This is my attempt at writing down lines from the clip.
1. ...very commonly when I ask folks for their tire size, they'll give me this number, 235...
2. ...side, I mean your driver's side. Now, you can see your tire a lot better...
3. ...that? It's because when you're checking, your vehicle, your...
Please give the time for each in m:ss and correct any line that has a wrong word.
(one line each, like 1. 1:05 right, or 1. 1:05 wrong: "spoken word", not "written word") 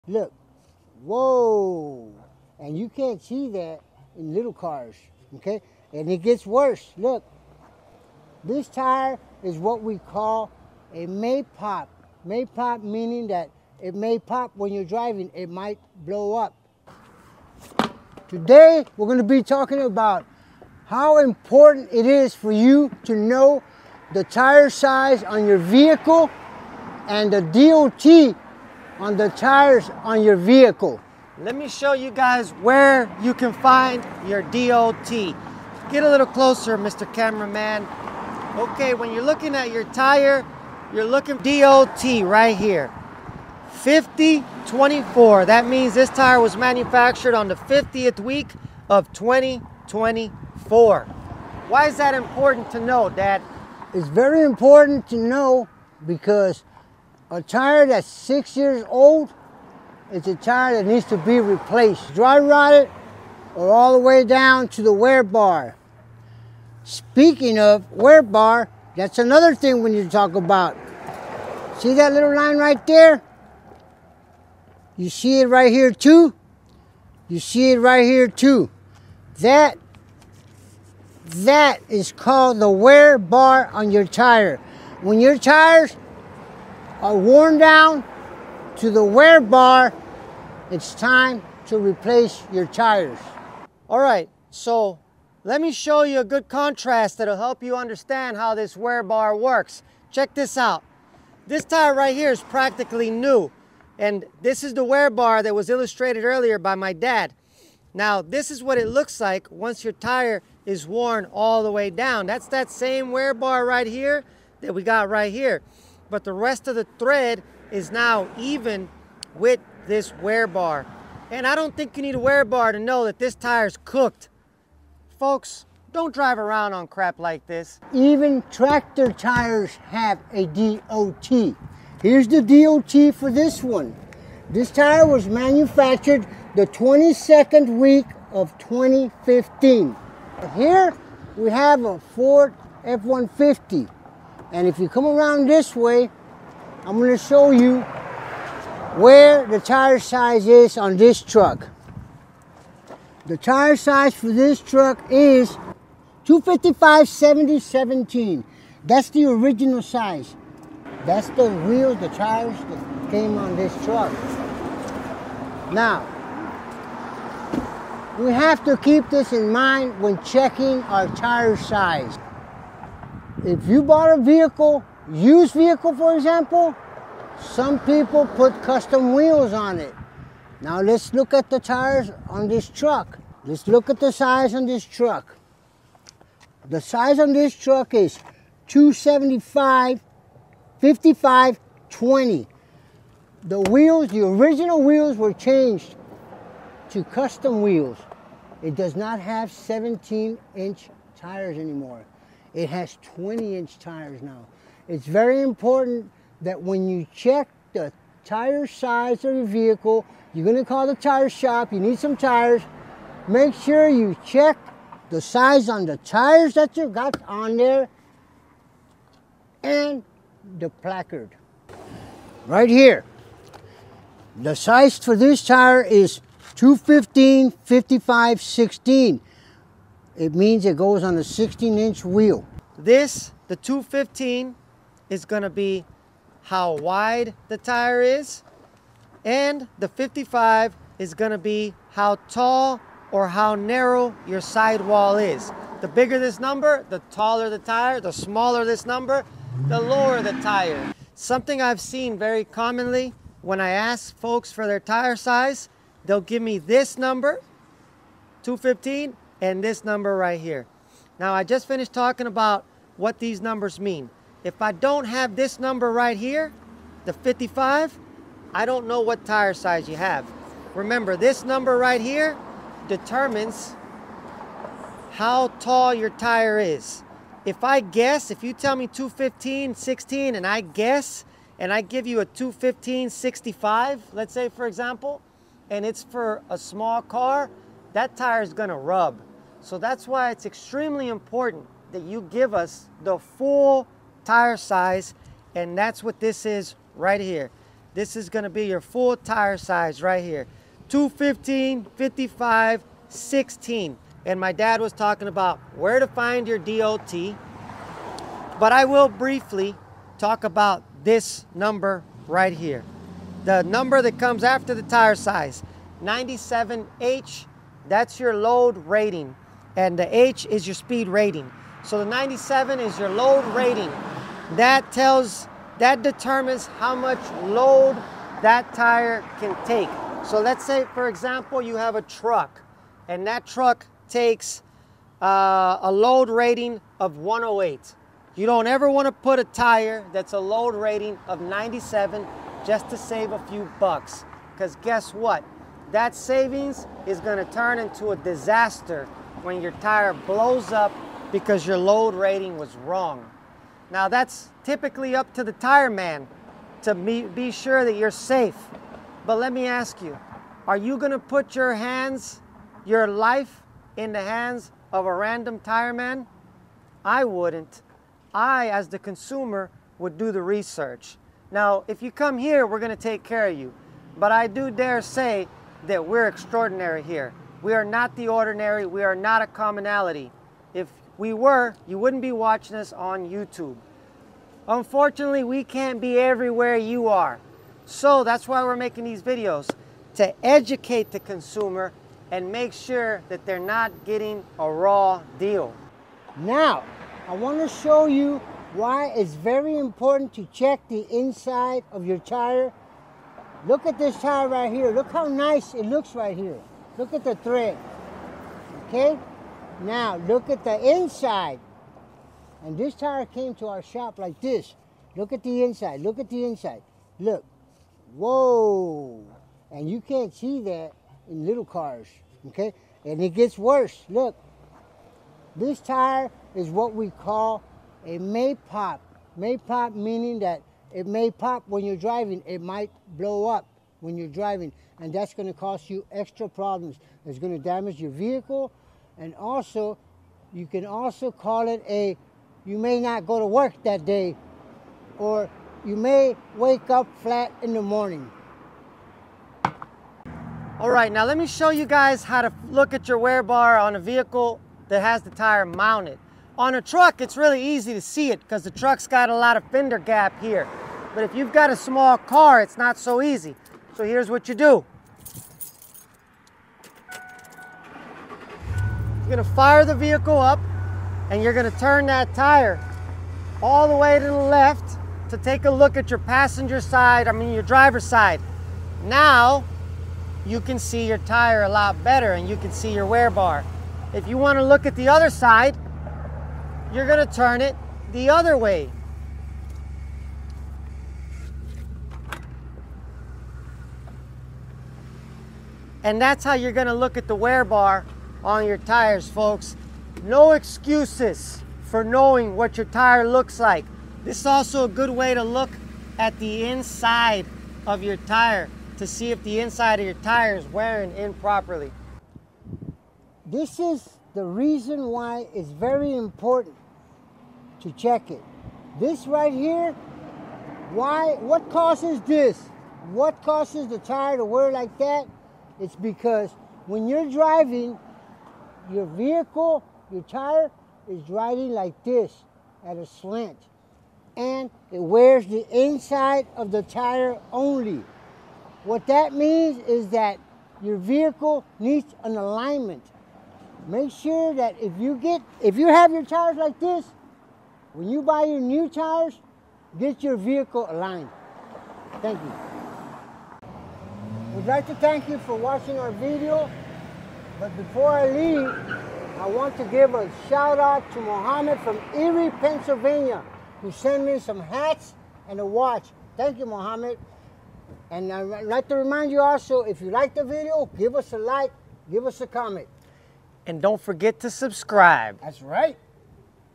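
1. 4:12 wrong: "215", not "235"
2. 7:56 right
3. 8:44 wrong: "driving", not "checking".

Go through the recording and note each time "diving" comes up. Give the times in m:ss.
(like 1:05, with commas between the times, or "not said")
not said.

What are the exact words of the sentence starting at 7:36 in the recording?
On a truck, it's really easy to see it because the truck's got a lot of fender gap here.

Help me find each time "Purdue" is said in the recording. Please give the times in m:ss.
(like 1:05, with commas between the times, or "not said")
not said.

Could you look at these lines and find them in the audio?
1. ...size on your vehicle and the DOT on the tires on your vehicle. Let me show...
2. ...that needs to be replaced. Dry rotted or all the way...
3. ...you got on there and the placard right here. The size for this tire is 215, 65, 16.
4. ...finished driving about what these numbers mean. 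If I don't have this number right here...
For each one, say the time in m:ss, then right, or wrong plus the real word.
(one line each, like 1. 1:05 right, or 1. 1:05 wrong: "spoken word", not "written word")
1. 0:24 right
2. 1:00 right
3. 3:36 wrong: "55", not "65"
4. 4:21 wrong: "talking", not "driving".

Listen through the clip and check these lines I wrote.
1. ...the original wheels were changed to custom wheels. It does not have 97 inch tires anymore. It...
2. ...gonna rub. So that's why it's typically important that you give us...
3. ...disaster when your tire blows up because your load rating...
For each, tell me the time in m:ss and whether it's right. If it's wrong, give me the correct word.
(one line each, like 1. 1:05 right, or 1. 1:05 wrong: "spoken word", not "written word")
1. 3:14 wrong: "17", not "97"
2. 4:48 wrong: "extremely", not "typically"
3. 5:48 right.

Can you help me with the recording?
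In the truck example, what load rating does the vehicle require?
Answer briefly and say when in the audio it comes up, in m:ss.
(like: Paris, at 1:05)
108, at 5:37.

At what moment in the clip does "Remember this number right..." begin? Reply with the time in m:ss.
4:30.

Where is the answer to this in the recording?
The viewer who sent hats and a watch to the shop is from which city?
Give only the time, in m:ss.
9:22.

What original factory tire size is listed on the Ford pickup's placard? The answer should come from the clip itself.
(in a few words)
255 70 17.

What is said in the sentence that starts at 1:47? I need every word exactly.
Now, this is what it looks like once your tire is worn all the way down.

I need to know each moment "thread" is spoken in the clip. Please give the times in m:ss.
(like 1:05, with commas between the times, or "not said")
1:56, 6:47.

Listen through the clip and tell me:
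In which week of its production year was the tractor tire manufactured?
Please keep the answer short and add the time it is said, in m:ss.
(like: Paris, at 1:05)
22nd, at 2:16.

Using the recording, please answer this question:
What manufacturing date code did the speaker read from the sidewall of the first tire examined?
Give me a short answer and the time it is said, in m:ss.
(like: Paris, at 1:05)
5024, at 0:43.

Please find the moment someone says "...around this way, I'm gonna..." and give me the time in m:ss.
2:25.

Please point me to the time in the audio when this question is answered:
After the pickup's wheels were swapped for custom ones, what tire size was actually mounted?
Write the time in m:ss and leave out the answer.
3:08.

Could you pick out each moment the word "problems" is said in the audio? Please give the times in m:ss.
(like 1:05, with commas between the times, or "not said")
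7:16.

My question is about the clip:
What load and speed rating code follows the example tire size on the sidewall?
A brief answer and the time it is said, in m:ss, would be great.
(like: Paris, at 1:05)
97H, at 5:16.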